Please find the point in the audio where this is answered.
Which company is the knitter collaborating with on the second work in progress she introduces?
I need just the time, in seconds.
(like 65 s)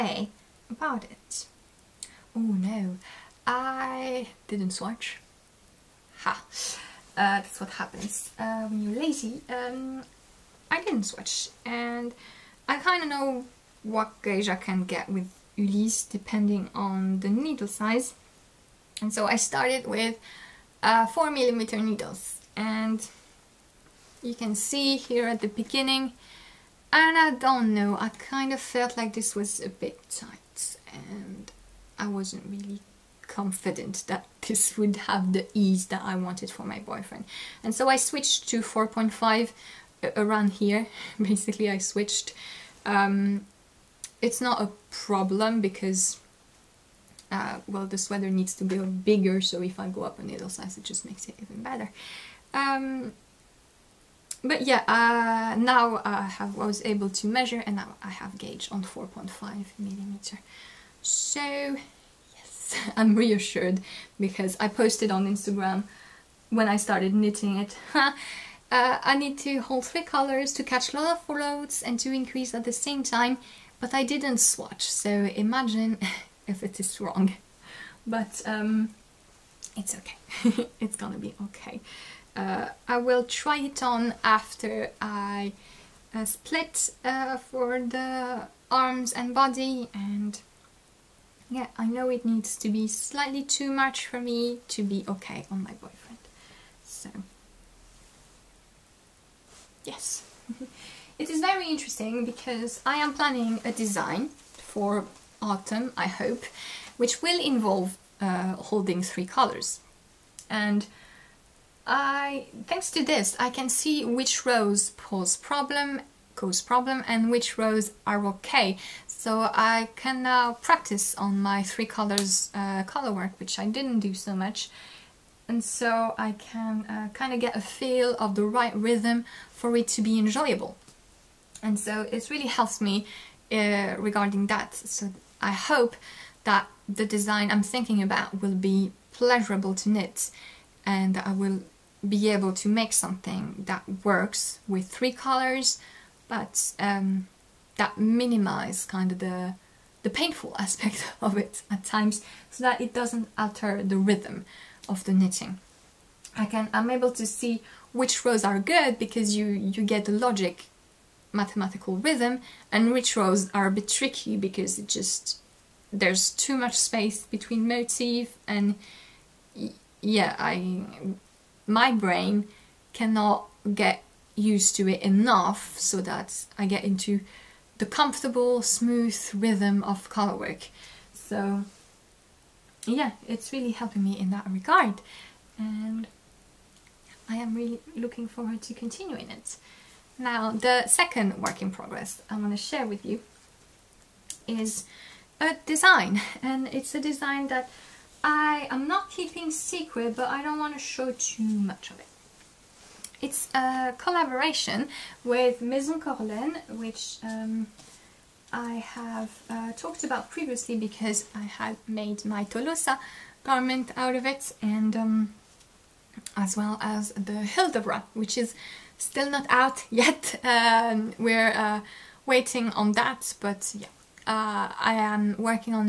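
205 s.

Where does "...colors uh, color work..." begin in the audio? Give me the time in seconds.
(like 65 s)
121 s.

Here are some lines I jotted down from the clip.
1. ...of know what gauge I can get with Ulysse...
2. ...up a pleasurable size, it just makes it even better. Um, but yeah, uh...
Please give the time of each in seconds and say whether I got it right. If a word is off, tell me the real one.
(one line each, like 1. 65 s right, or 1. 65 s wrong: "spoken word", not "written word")
1. 13 s right
2. 50 s wrong: "needle", not "pleasurable".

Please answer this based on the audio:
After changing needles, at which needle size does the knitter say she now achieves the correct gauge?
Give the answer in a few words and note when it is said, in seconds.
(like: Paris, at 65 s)
4.5 millimeter, at 58 s.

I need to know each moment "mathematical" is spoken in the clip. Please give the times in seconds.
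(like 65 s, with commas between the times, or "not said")
161 s.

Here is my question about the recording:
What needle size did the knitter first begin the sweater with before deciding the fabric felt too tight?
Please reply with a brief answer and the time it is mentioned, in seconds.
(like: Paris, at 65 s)
4 millimeter, at 21 s.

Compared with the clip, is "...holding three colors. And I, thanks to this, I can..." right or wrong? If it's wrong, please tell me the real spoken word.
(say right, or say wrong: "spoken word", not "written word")
right.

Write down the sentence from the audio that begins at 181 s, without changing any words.
So yeah, it's really helping me in that regard.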